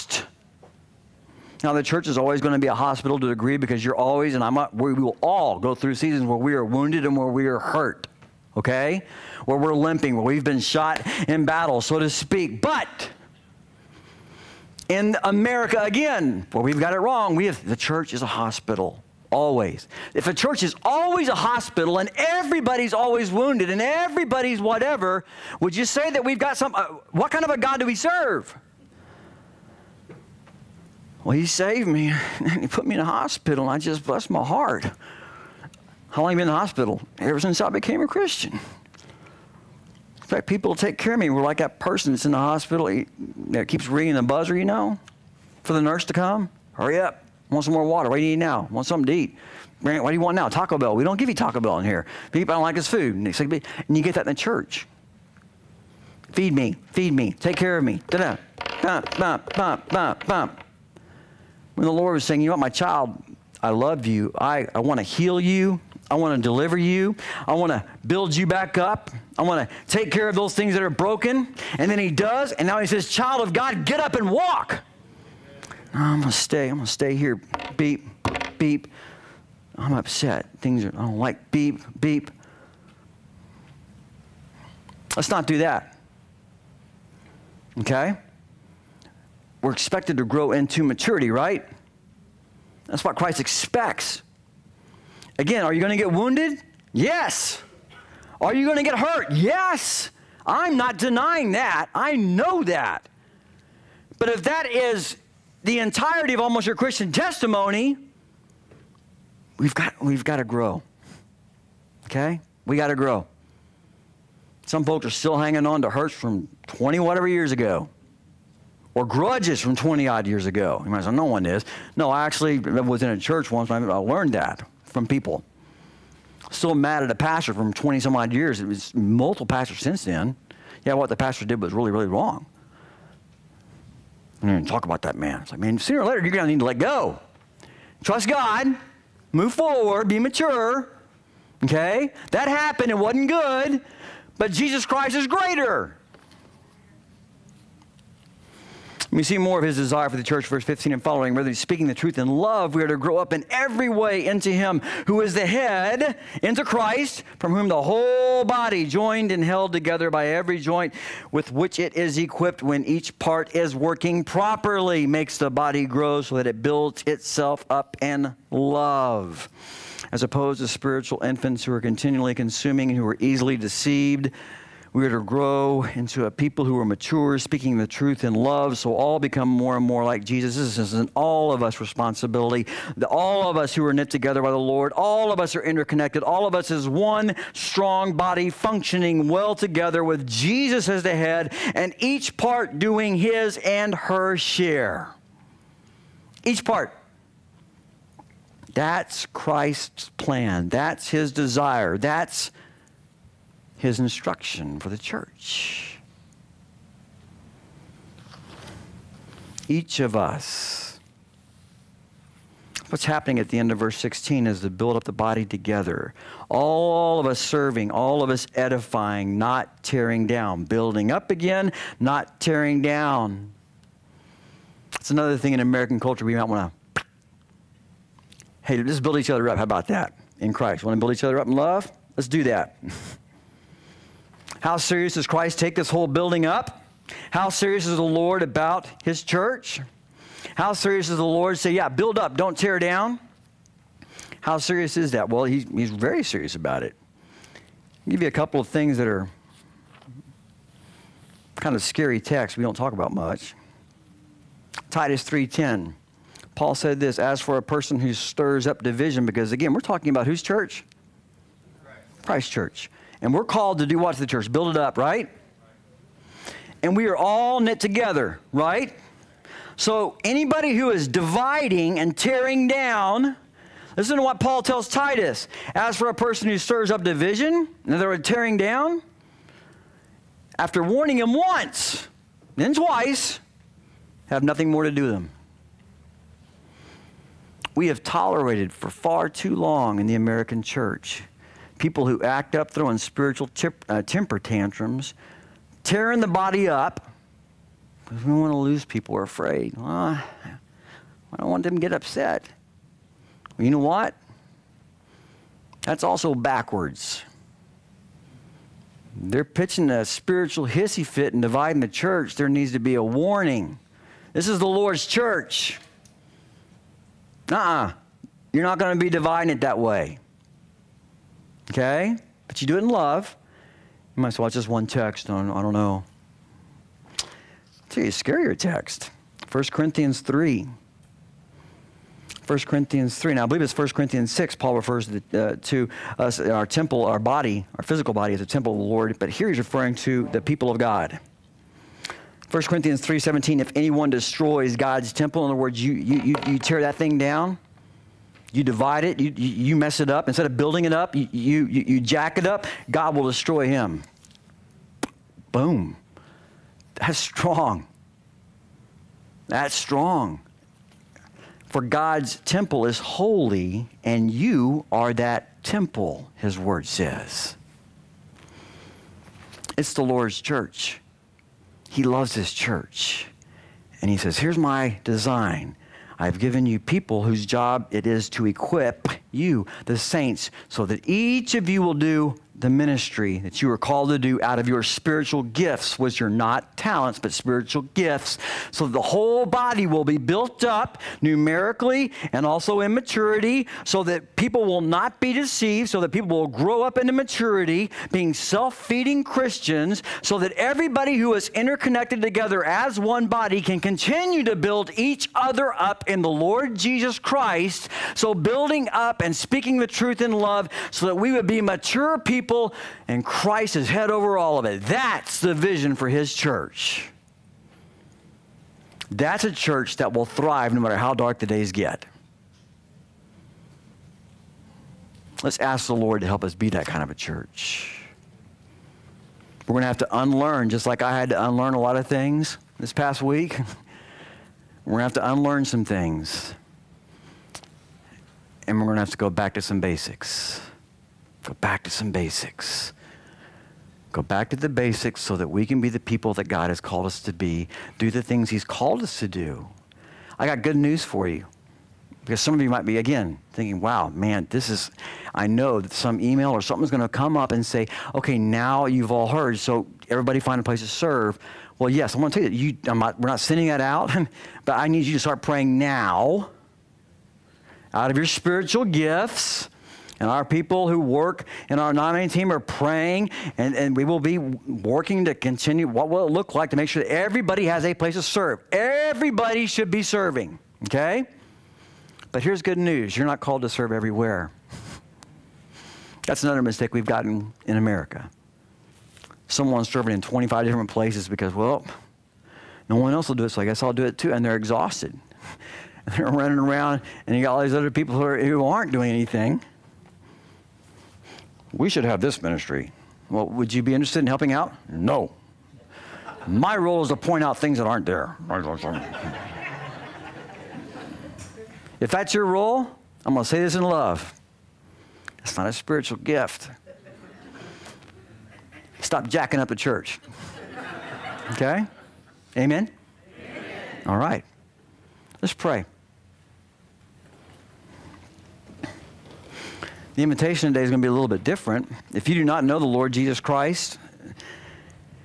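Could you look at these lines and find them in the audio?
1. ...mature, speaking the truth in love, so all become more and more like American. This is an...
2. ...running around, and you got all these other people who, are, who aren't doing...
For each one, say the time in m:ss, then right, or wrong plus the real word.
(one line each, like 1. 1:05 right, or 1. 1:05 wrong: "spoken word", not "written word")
1. 2:56 wrong: "Jesus", not "American"
2. 8:16 right.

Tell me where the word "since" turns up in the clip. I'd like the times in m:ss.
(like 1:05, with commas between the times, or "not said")
0:37, 2:09.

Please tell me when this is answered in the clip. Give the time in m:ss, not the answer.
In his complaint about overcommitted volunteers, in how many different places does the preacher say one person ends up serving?
8:10.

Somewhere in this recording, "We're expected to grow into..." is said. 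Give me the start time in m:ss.
1:29.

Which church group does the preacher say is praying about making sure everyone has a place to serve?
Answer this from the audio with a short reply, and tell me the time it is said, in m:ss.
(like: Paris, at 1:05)
nominating team, at 7:51.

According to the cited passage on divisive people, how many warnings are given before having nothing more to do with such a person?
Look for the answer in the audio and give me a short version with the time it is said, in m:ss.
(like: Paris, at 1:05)
2, at 4:42.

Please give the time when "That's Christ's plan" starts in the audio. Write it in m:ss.
3:18.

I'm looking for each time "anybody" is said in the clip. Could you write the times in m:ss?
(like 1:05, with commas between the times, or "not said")
4:30.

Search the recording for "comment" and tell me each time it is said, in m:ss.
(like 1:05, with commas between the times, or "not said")
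not said.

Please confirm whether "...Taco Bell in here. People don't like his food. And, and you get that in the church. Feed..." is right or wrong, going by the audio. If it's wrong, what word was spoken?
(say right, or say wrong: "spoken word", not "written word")
right.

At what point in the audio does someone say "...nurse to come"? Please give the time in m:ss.
0:45.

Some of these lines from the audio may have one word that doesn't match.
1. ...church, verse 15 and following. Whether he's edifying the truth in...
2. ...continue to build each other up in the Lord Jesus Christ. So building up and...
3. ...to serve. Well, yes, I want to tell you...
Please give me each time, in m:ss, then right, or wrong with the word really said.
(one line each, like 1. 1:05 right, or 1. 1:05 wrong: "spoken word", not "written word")
1. 2:30 wrong: "speaking", not "edifying"
2. 6:43 right
3. 7:40 right.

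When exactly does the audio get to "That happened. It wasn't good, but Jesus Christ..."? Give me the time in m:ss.
2:22.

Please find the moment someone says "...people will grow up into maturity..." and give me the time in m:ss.
6:36.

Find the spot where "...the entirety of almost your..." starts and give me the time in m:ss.
1:45.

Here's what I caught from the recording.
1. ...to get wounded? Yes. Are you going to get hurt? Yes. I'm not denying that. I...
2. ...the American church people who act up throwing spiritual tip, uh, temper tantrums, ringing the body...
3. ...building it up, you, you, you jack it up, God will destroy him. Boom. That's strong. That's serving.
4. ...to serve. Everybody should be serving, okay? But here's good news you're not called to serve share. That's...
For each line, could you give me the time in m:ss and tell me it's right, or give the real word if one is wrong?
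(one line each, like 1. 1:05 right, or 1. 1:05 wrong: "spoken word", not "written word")
1. 1:35 right
2. 4:50 wrong: "tearing", not "ringing"
3. 5:50 wrong: "strong", not "serving"
4. 7:58 wrong: "everywhere", not "share".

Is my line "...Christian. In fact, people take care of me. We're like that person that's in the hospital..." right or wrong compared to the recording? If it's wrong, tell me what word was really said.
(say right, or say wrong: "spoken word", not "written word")
right.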